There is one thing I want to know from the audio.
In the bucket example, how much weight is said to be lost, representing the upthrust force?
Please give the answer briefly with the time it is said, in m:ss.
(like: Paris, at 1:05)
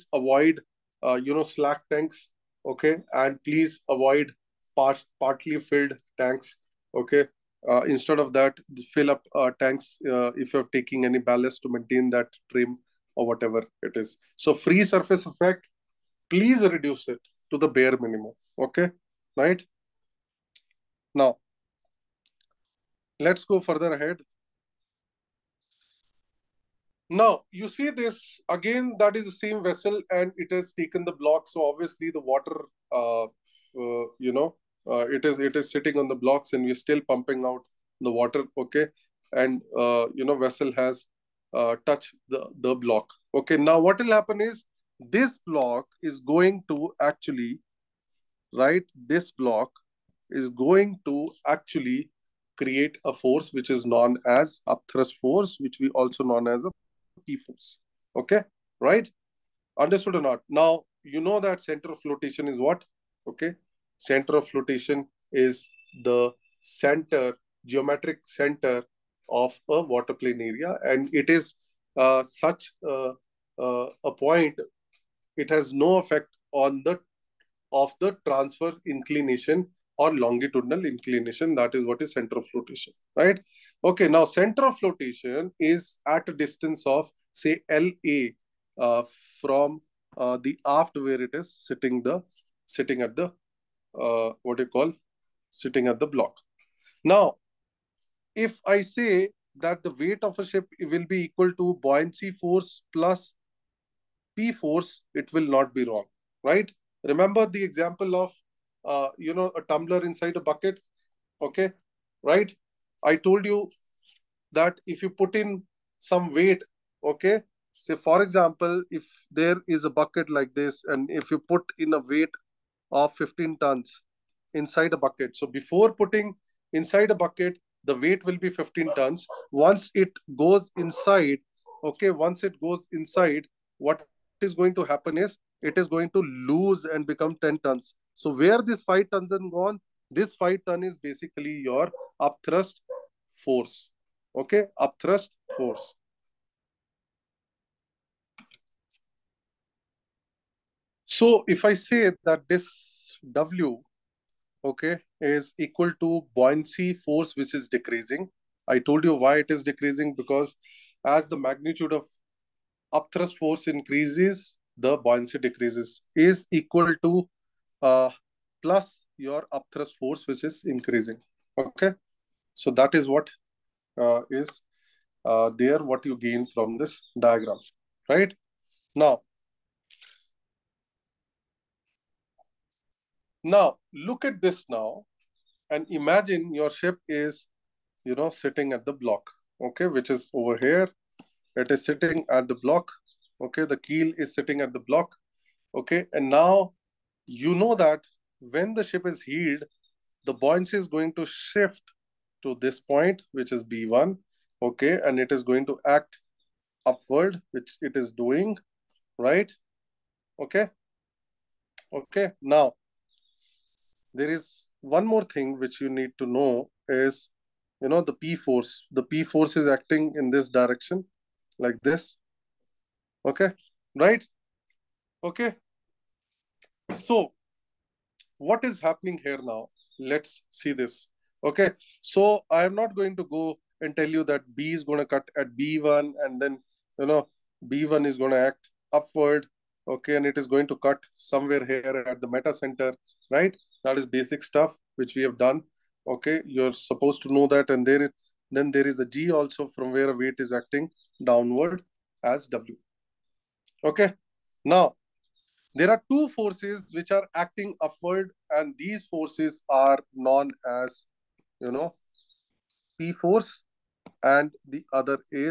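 5 tons, at 2:20.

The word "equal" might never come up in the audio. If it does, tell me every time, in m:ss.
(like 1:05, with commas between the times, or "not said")
1:41, 2:35, 2:46.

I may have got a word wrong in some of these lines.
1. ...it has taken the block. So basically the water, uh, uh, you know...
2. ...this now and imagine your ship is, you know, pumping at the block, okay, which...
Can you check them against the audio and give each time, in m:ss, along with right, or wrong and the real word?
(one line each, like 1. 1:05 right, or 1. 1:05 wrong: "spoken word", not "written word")
1. 0:30 wrong: "obviously", not "basically"
2. 3:04 wrong: "sitting", not "pumping".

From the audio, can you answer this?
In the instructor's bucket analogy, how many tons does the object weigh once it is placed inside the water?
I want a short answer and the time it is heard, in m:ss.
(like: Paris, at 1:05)
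10 tons, at 2:17.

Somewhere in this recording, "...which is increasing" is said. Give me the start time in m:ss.
2:50.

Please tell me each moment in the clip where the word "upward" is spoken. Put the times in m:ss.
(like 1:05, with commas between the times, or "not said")
3:26, 3:58, 4:17.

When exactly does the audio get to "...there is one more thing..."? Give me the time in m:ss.
3:34.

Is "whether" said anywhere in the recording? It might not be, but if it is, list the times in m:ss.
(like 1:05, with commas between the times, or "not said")
not said.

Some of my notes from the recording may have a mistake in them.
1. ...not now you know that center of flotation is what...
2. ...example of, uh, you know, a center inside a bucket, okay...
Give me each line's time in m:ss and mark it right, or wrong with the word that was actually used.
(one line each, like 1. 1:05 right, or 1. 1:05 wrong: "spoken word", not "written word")
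1. 1:00 right
2. 1:47 wrong: "tumbler", not "center".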